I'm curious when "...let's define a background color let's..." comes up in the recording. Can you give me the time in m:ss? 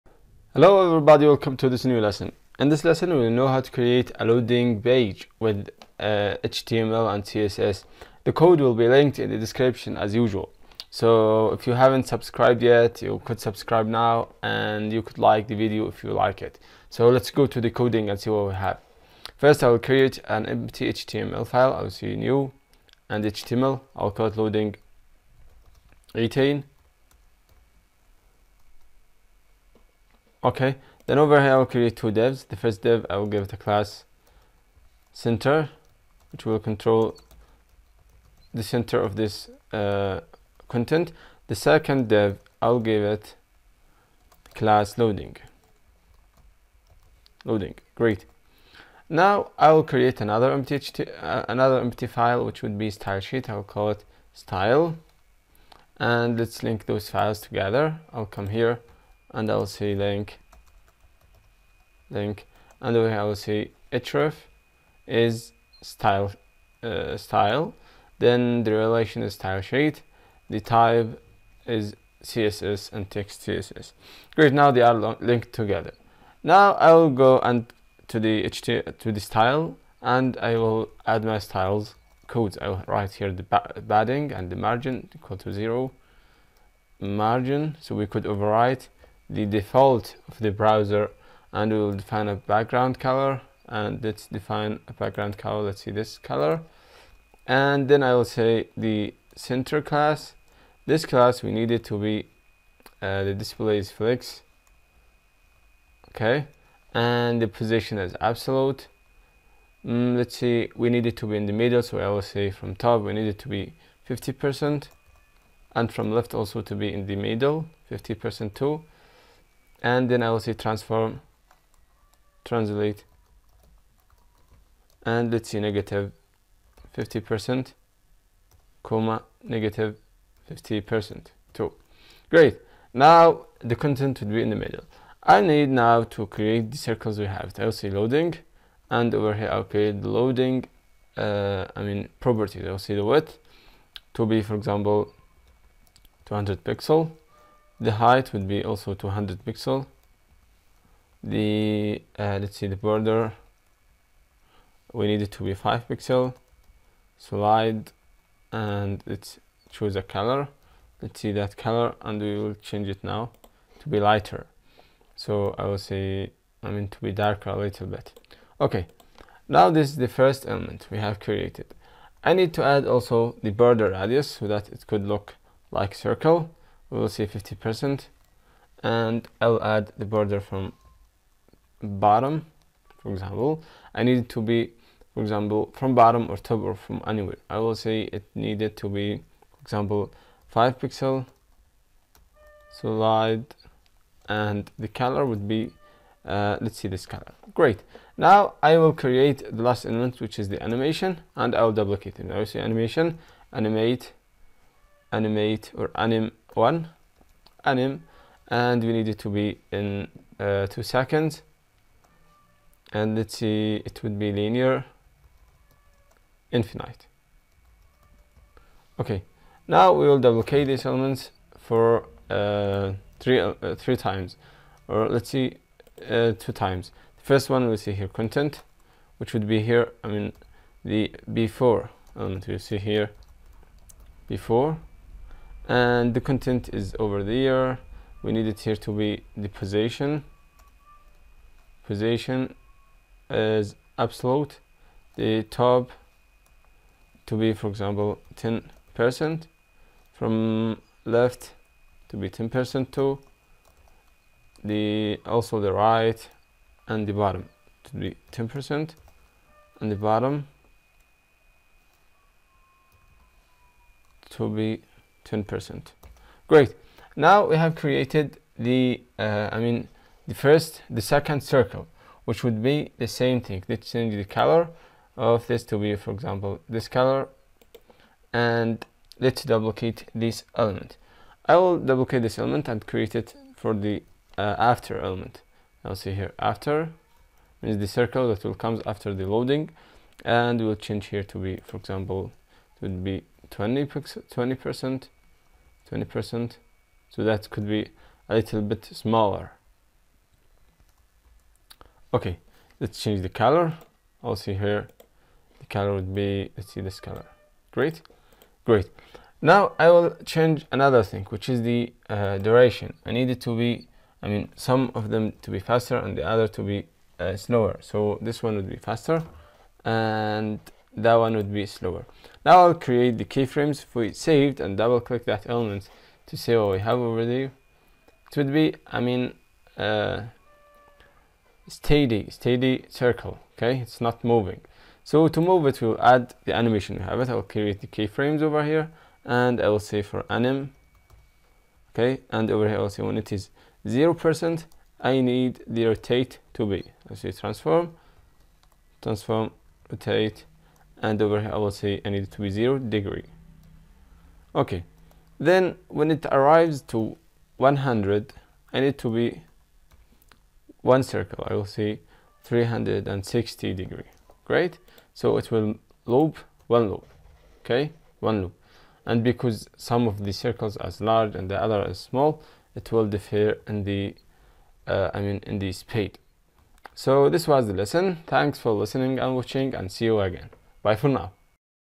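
1:34.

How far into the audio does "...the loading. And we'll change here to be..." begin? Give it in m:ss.
4:49.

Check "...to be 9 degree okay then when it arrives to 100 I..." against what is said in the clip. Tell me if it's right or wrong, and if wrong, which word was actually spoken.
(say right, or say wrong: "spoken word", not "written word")
wrong: "0", not "9".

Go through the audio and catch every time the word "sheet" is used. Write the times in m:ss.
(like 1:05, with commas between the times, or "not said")
0:53, 1:09.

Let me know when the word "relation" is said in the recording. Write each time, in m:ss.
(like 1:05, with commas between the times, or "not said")
1:08.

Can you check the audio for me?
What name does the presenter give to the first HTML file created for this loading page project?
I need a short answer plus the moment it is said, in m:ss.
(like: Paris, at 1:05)
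loading 18, at 0:24.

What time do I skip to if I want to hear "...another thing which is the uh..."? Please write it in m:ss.
5:10.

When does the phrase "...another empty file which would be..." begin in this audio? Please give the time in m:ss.
0:51.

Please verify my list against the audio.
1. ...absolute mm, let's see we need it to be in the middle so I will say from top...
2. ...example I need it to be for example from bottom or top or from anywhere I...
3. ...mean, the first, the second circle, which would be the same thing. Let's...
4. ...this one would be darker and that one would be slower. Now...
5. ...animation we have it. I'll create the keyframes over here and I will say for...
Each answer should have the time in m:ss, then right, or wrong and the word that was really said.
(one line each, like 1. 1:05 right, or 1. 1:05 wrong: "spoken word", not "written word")
1. 1:48 right
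2. 3:03 right
3. 4:29 right
4. 5:18 wrong: "faster", not "darker"
5. 5:36 right.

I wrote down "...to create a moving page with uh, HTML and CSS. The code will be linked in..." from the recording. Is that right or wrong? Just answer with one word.
wrong.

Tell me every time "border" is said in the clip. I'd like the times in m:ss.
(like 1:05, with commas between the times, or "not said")
2:32, 2:53, 3:00.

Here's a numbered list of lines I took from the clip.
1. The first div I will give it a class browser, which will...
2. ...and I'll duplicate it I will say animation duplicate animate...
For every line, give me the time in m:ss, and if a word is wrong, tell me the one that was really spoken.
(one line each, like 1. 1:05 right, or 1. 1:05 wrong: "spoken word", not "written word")
1. 0:32 wrong: "center", not "browser"
2. 3:21 wrong: "animate", not "duplicate".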